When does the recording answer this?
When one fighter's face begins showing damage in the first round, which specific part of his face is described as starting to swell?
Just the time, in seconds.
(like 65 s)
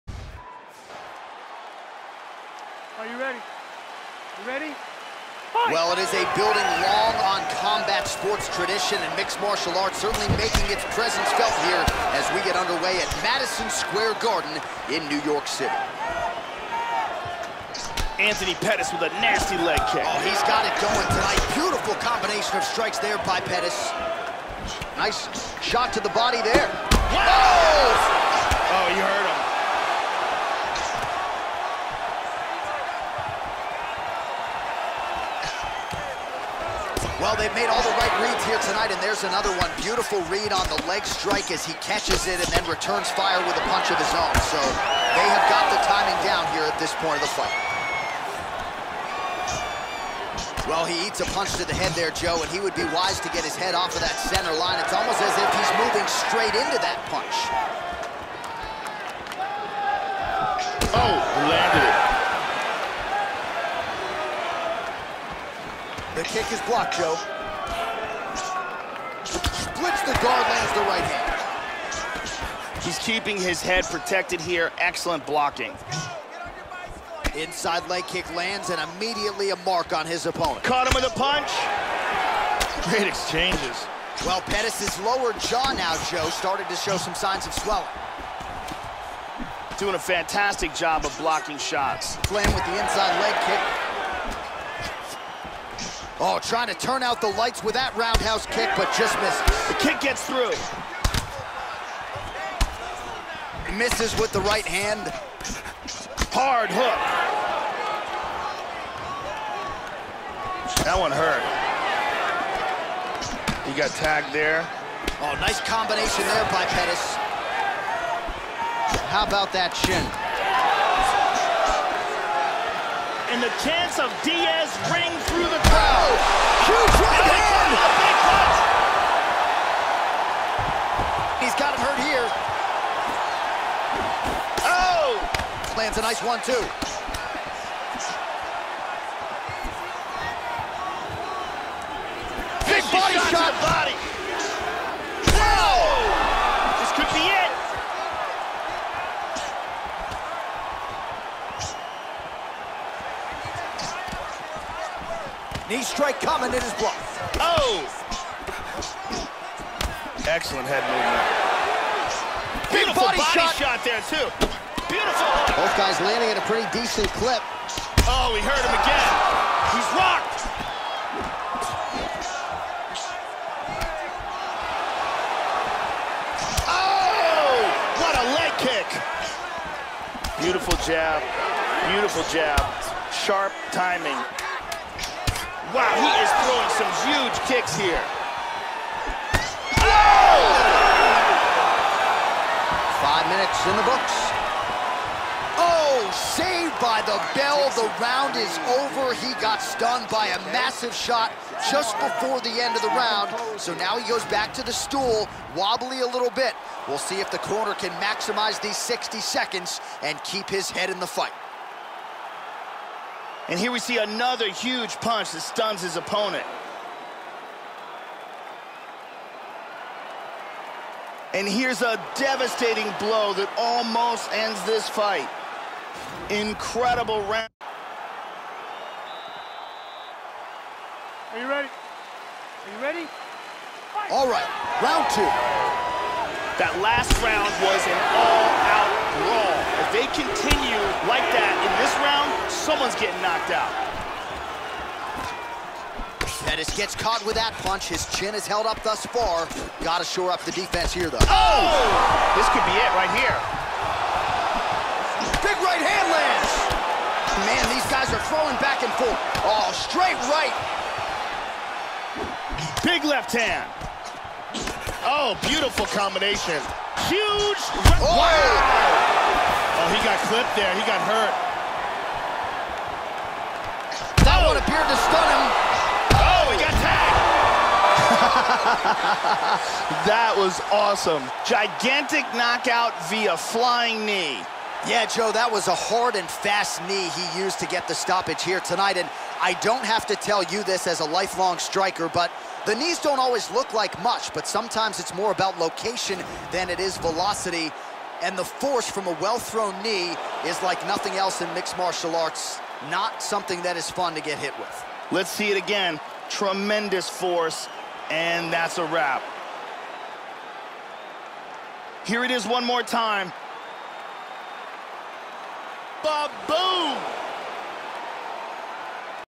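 85 s.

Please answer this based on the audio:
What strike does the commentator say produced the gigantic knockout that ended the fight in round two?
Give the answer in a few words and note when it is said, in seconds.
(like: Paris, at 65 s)
flying knee, at 283 s.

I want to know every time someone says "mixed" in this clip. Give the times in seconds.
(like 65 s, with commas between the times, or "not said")
9 s, 301 s.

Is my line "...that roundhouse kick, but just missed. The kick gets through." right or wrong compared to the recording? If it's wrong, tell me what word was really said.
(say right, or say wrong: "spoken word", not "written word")
right.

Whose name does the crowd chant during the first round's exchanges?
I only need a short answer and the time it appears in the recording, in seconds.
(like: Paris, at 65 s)
Diaz, at 124 s.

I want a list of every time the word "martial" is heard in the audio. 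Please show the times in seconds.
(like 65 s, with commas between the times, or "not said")
9 s, 301 s.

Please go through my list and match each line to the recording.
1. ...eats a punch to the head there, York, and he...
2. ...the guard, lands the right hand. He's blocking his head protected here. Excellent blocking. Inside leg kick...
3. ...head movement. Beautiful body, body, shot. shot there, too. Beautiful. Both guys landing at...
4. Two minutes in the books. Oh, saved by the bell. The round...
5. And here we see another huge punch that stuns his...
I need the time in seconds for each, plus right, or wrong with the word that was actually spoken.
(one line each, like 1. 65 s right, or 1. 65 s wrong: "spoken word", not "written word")
1. 51 s wrong: "Joe", not "York"
2. 70 s wrong: "keeping", not "blocking"
3. 160 s right
4. 192 s wrong: "Five", not "Two"
5. 213 s right.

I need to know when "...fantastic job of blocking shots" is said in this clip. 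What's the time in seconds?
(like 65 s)
89 s.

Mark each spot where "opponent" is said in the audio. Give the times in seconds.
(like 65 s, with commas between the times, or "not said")
80 s, 215 s.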